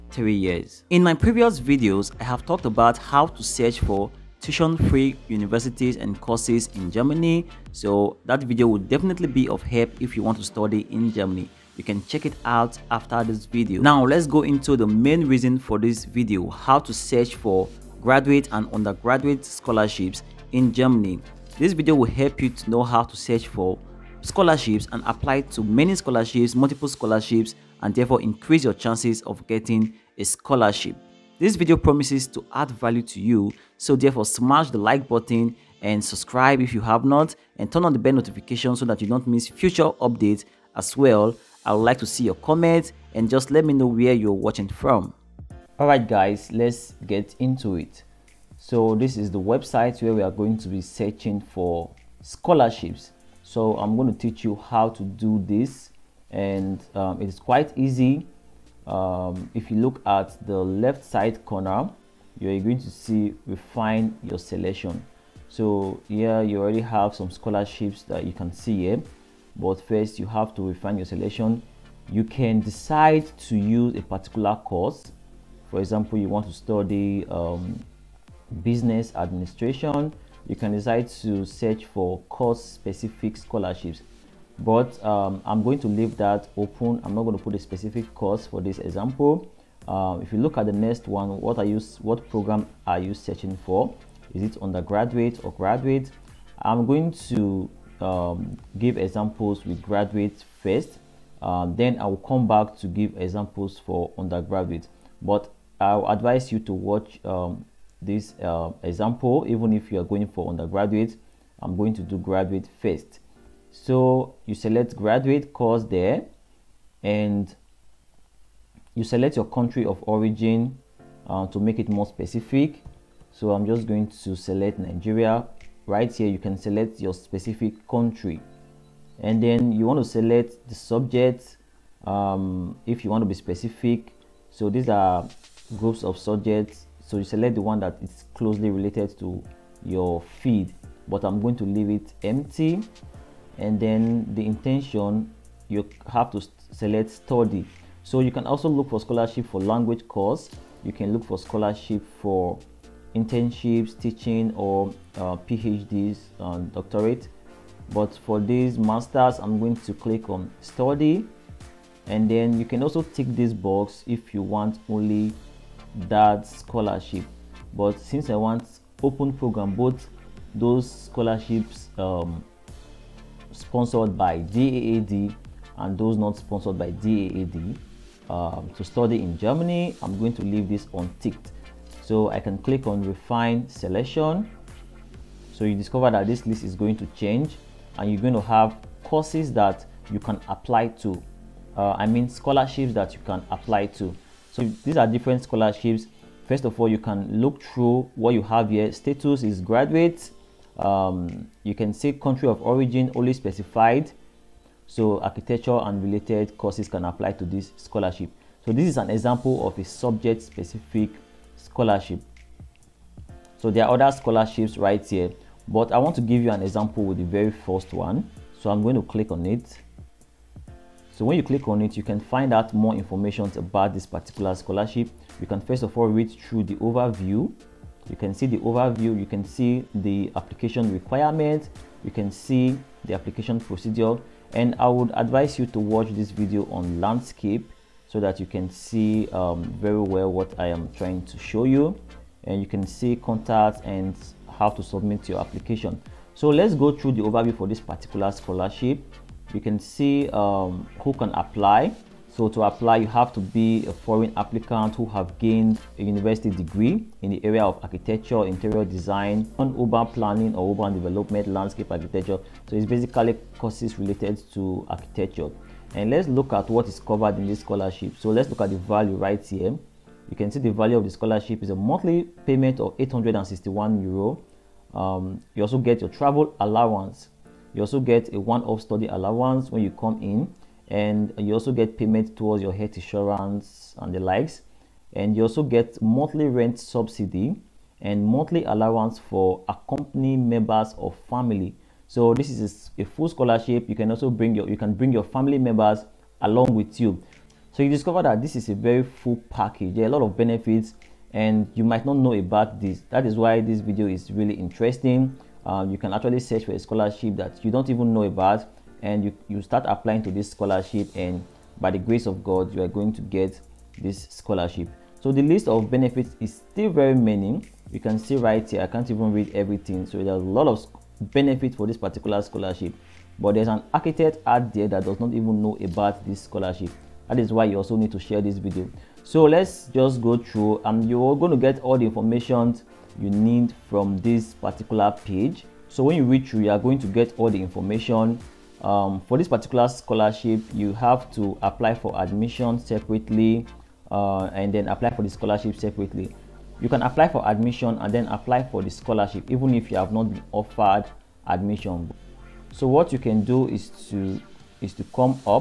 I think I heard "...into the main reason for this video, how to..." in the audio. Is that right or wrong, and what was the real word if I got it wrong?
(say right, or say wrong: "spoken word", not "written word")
right.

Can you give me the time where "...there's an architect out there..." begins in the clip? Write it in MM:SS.
05:23.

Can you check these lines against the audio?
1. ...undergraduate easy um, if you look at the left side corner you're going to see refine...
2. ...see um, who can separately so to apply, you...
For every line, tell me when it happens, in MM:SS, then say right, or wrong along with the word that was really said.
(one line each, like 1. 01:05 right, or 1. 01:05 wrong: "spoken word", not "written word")
1. 00:57 wrong: "quite", not "undergraduate"
2. 04:09 wrong: "apply", not "separately".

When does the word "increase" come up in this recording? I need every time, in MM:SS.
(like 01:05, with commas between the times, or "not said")
00:28.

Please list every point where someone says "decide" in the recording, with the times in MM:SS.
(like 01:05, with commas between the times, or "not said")
01:12, 01:20.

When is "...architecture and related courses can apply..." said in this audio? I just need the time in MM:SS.
03:25.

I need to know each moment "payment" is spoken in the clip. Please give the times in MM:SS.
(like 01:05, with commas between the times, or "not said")
04:32, 04:41.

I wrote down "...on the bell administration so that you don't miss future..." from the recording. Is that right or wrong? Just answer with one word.
wrong.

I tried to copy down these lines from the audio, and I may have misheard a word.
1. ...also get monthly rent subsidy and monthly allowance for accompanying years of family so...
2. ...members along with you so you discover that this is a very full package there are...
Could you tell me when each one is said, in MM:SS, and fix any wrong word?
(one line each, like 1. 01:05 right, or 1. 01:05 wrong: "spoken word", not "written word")
1. 04:45 wrong: "members", not "years"
2. 04:55 right.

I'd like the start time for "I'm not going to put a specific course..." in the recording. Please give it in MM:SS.
01:27.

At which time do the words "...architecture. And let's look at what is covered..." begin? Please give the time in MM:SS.
04:24.